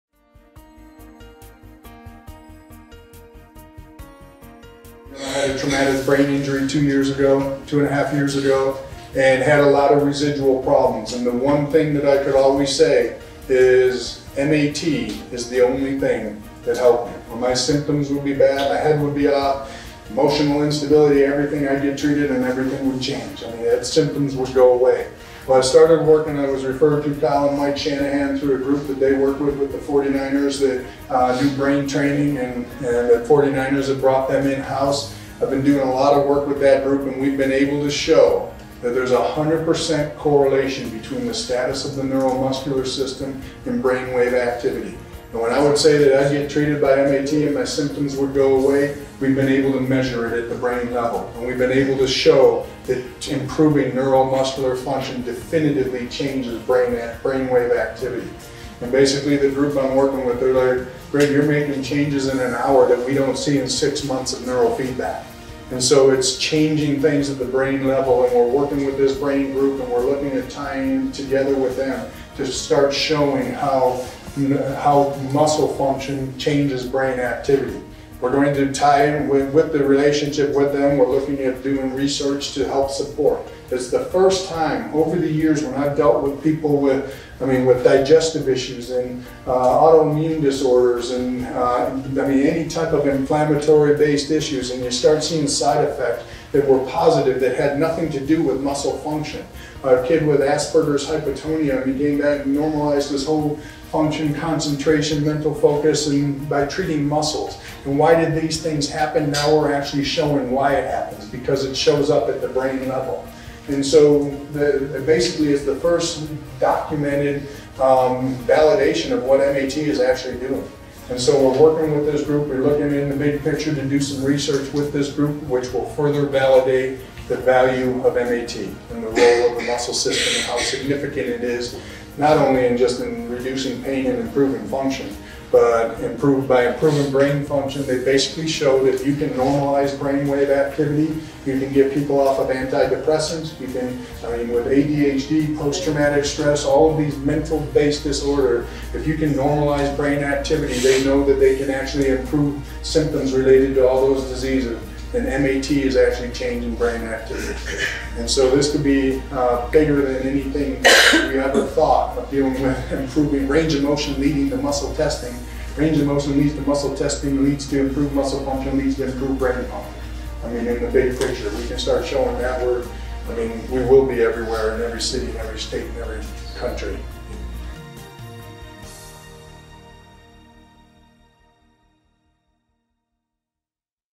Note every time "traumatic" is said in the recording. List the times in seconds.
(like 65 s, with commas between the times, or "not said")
5 s, 145 s.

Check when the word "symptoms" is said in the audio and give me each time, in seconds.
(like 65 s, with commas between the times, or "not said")
17 s, 23 s, 47 s, 152 s.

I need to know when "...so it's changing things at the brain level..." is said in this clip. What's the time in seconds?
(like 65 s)
65 s.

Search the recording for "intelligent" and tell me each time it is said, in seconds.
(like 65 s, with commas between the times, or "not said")
not said.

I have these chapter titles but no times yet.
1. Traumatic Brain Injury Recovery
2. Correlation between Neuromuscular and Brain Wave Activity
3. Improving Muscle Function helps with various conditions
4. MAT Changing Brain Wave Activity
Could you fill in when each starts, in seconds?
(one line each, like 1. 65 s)
1. 11 s
2. 37 s
3. 84 s
4. 135 s.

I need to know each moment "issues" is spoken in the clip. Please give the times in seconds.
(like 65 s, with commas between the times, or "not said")
88 s, 94 s.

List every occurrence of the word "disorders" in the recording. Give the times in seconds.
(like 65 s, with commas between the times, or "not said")
90 s, 148 s.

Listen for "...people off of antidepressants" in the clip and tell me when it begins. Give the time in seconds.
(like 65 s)
141 s.